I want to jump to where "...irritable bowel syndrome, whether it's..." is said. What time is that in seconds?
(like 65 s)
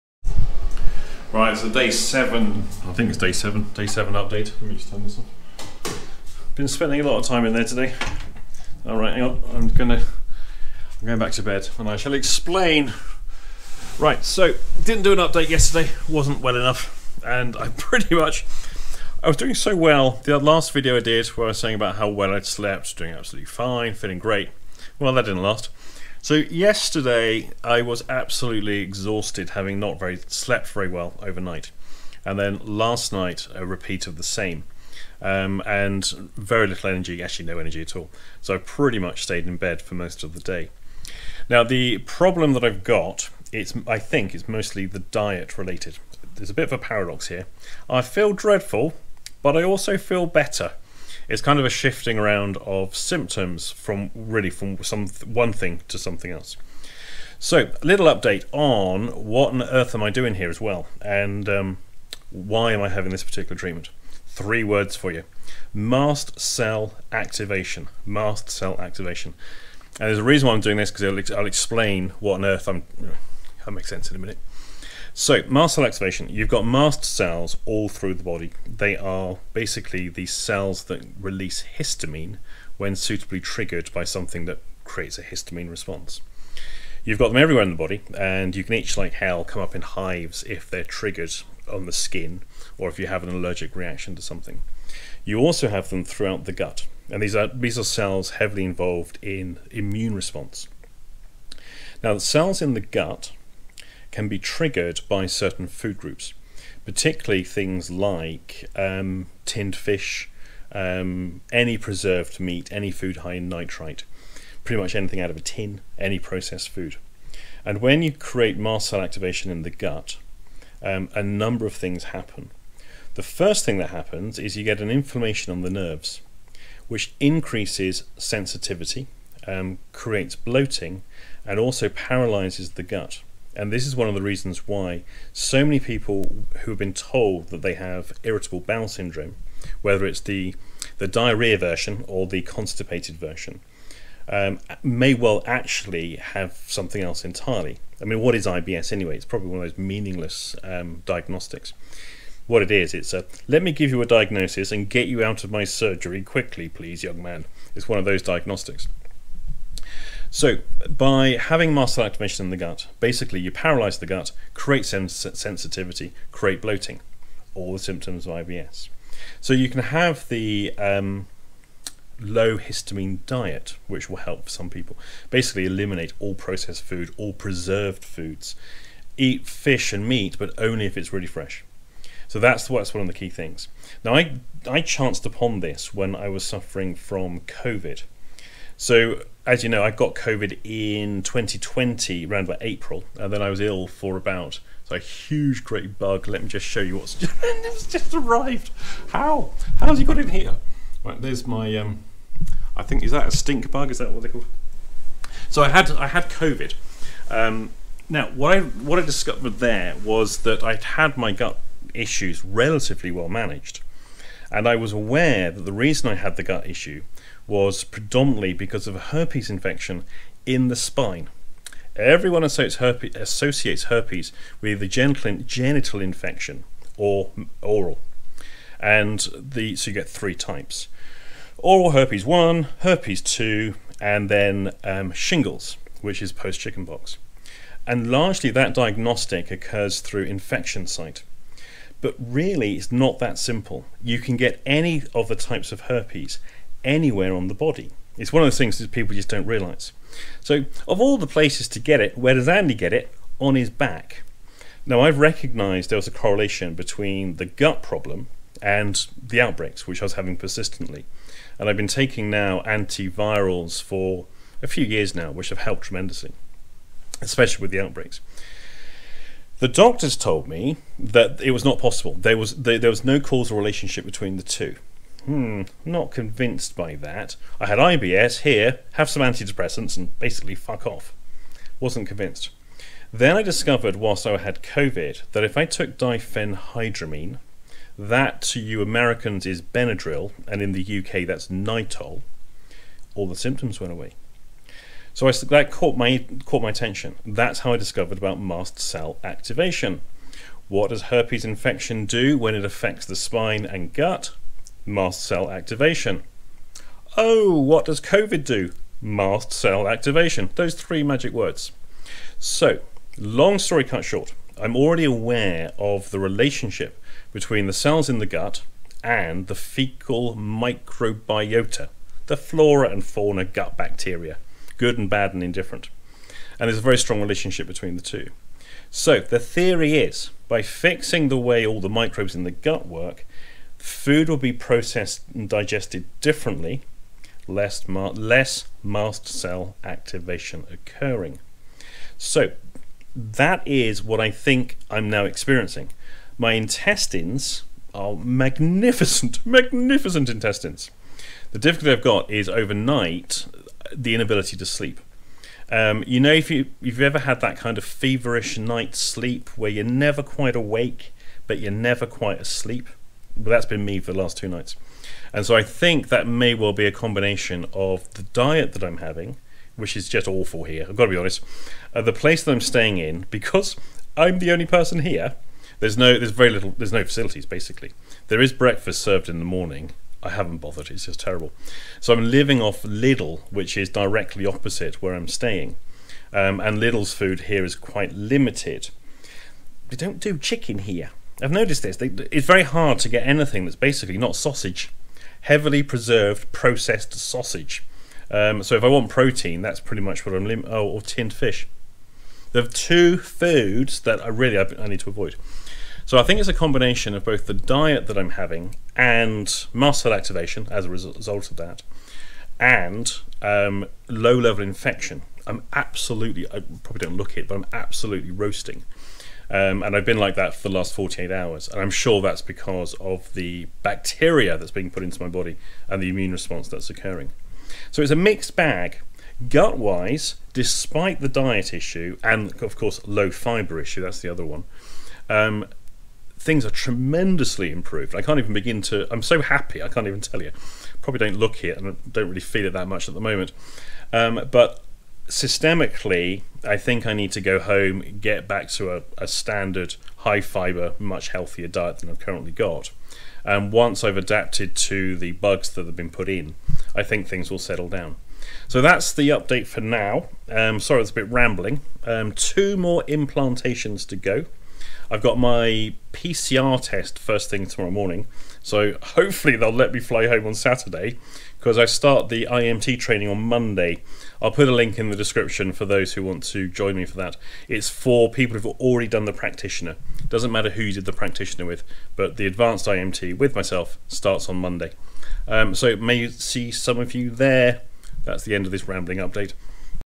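138 s.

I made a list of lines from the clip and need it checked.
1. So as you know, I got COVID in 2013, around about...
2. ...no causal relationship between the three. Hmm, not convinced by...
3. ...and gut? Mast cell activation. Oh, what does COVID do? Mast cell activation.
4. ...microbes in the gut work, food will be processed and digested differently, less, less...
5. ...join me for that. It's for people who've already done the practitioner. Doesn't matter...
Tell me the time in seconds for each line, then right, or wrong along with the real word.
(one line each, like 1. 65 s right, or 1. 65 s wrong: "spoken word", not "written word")
1. 188 s wrong: "2020", not "2013"
2. 273 s wrong: "two", not "three"
3. 303 s right
4. 331 s right
5. 476 s right.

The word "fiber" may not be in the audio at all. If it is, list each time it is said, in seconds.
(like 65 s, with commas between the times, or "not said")
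433 s, 450 s.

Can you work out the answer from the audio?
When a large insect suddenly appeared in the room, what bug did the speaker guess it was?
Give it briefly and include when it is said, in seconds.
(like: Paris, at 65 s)
stink bug, at 203 s.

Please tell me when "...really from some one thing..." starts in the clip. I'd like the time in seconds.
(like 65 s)
54 s.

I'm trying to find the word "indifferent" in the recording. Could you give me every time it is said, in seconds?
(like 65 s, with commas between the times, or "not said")
325 s.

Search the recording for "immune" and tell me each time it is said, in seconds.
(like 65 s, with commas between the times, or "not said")
99 s, 426 s.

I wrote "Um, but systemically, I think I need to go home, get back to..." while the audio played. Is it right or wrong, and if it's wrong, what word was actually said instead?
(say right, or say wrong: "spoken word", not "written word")
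right.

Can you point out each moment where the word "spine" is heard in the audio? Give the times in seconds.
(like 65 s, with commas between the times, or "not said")
220 s, 303 s.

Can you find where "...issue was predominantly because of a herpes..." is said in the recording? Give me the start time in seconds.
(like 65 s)
216 s.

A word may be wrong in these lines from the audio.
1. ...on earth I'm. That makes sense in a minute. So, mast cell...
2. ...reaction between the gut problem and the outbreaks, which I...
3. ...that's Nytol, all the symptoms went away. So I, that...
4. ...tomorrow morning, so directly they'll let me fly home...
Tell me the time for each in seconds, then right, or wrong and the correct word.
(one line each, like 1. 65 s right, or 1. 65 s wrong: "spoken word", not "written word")
1. 72 s right
2. 256 s wrong: "correlation", not "reaction"
3. 291 s right
4. 467 s wrong: "hopefully", not "directly".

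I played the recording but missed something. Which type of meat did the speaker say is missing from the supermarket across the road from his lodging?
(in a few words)
chicken.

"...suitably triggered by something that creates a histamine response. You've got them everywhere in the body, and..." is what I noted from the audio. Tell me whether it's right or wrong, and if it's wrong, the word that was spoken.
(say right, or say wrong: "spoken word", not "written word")
right.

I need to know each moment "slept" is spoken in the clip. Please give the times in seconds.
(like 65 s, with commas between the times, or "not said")
22 s, 30 s.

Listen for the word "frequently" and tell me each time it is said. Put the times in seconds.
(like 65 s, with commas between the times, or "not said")
not said.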